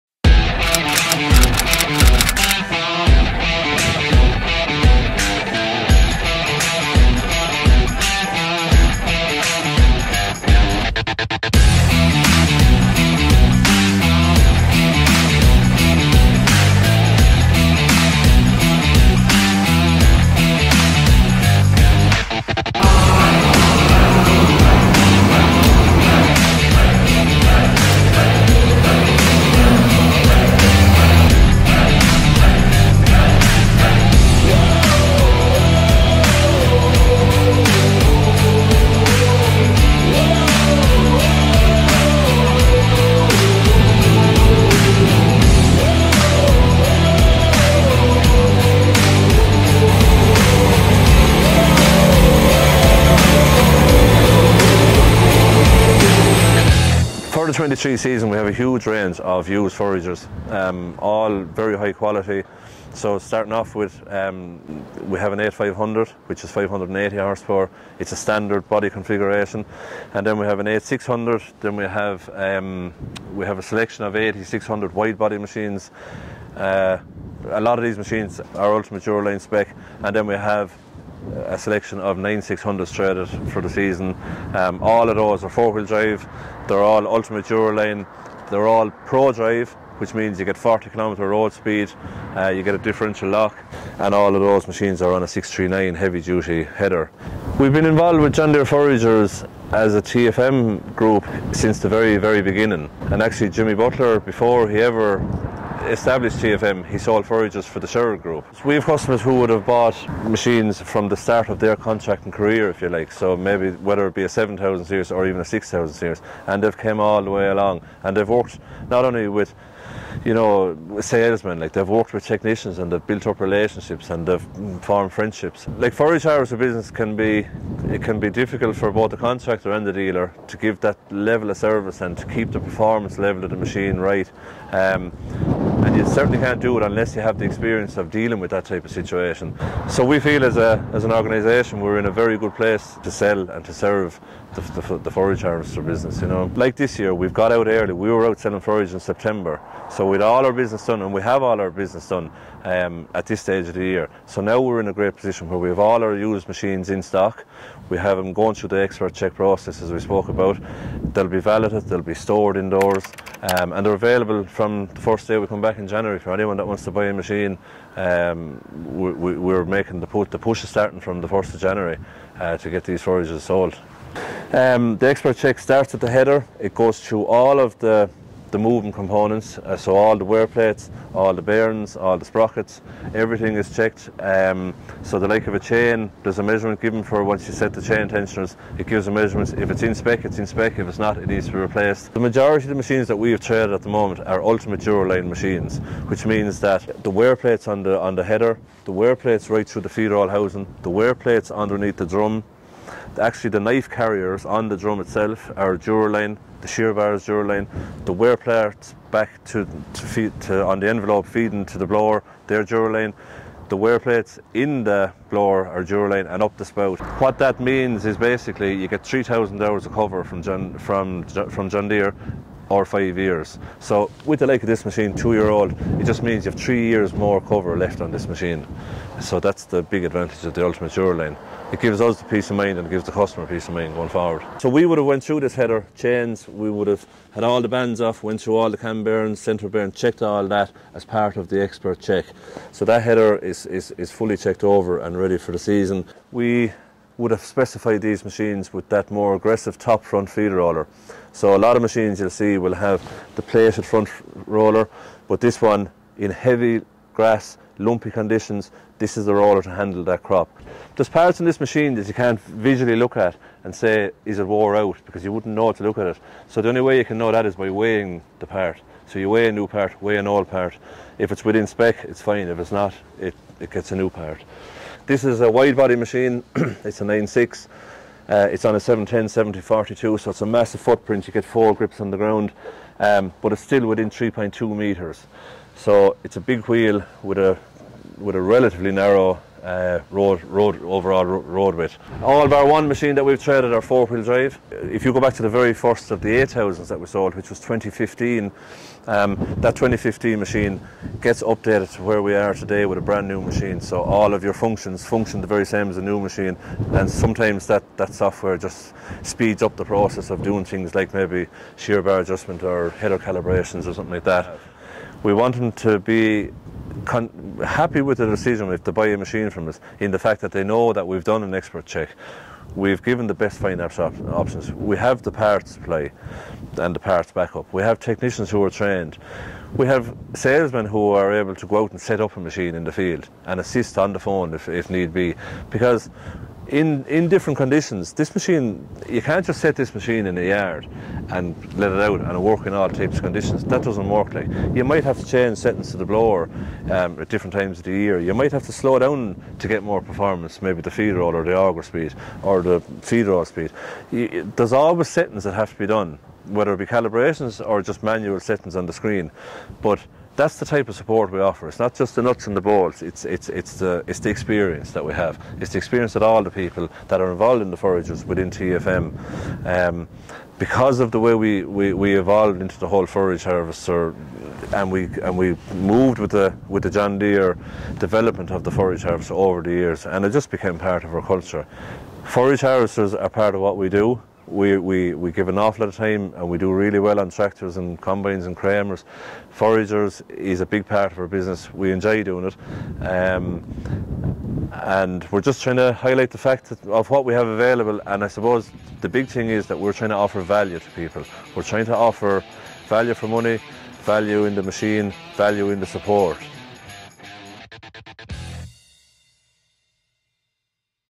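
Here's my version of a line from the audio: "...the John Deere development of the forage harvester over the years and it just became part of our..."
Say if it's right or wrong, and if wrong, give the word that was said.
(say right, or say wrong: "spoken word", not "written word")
right.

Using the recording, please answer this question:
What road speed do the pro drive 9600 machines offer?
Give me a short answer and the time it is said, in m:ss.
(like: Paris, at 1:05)
40 kilometres, at 1:30.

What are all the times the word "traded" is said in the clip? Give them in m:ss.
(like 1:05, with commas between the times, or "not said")
1:22, 3:13, 4:53.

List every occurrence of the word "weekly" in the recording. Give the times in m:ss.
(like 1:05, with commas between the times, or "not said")
not said.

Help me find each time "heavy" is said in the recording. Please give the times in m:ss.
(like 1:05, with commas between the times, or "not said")
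1:35, 4:16.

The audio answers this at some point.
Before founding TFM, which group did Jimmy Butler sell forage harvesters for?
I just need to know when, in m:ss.
1:47.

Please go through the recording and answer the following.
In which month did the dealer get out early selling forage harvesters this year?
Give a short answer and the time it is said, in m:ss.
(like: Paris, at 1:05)
September, at 2:28.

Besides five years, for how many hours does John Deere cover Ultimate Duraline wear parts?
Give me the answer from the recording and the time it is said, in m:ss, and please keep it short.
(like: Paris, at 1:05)
3,000 hours, at 3:39.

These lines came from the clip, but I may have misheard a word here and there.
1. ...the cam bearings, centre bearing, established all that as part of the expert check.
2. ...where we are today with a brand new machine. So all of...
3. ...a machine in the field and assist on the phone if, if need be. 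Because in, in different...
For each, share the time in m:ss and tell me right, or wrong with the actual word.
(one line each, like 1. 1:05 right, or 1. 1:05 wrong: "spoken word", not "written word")
1. 3:58 wrong: "checked", not "established"
2. 5:02 right
3. 5:32 right.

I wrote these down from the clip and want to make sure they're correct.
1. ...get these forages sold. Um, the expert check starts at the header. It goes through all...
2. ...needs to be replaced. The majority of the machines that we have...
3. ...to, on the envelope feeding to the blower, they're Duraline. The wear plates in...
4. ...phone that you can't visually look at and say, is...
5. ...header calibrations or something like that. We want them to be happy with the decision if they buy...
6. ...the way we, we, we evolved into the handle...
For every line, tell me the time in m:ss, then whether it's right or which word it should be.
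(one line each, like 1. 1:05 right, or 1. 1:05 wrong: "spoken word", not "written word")
1. 2:52 right
2. 3:11 right
3. 3:30 right
4. 4:21 wrong: "machine", not "phone"
5. 5:12 right
6. 6:11 wrong: "whole", not "handle".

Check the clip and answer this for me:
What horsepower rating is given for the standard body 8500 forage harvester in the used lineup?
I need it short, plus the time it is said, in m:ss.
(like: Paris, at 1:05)
580, at 1:06.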